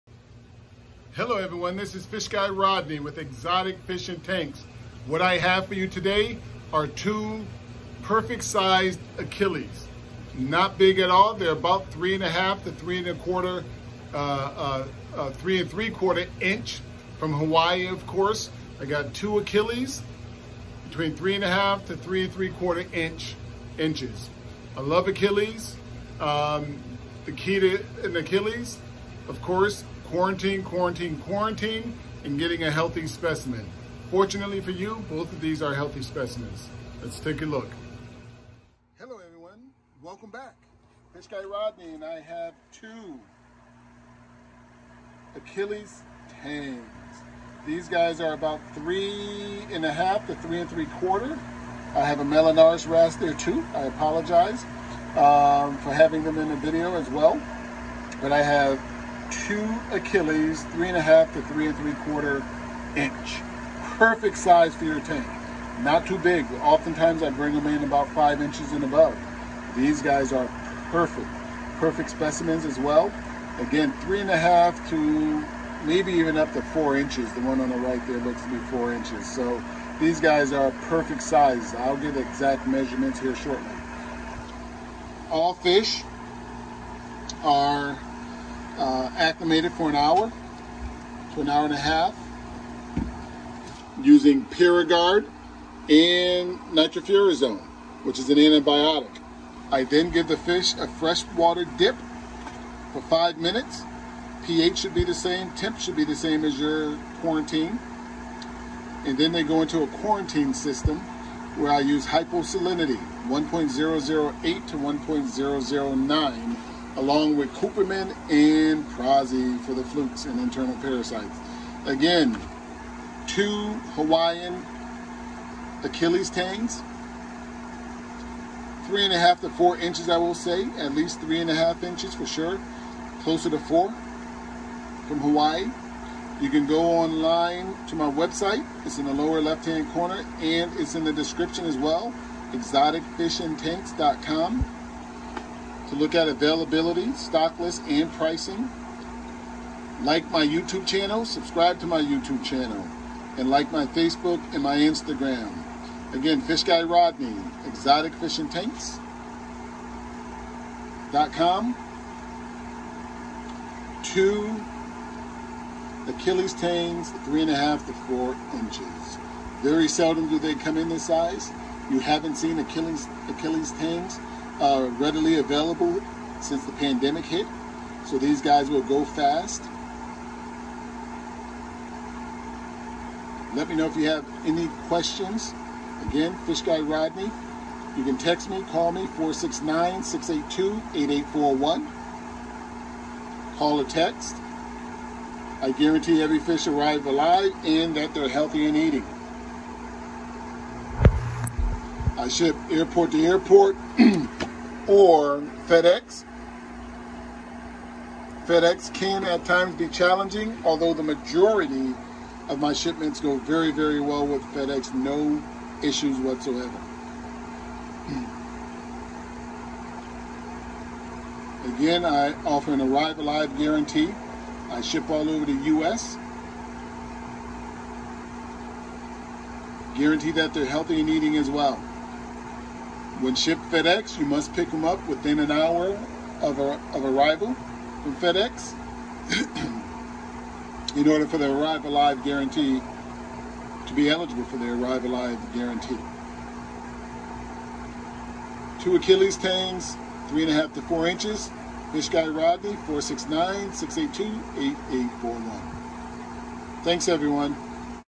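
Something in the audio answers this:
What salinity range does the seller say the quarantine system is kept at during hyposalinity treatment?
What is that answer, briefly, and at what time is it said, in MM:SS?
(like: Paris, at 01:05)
1.008 to 1.009, at 01:53.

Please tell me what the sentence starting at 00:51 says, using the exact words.
I have a Melanurus wrasse there too.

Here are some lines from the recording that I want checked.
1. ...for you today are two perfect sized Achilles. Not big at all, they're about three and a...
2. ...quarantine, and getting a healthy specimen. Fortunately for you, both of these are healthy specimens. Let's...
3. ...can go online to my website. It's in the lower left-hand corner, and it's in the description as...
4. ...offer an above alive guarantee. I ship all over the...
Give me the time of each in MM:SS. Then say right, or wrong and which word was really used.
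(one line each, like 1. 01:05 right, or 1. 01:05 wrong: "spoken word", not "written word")
1. 00:05 right
2. 00:31 right
3. 02:16 right
4. 03:42 wrong: "arrive", not "above".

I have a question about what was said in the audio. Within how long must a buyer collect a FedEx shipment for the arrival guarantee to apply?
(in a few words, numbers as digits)
Within an hour.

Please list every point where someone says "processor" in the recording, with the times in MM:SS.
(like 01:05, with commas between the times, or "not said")
not said.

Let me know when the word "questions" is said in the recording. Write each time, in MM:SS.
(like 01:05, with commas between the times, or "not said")
03:04.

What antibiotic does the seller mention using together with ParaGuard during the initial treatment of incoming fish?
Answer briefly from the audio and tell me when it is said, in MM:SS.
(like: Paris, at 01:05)
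Nitrofurazone, at 01:36.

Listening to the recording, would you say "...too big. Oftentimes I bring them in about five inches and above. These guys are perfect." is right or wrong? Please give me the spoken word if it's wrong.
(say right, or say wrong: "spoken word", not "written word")
right.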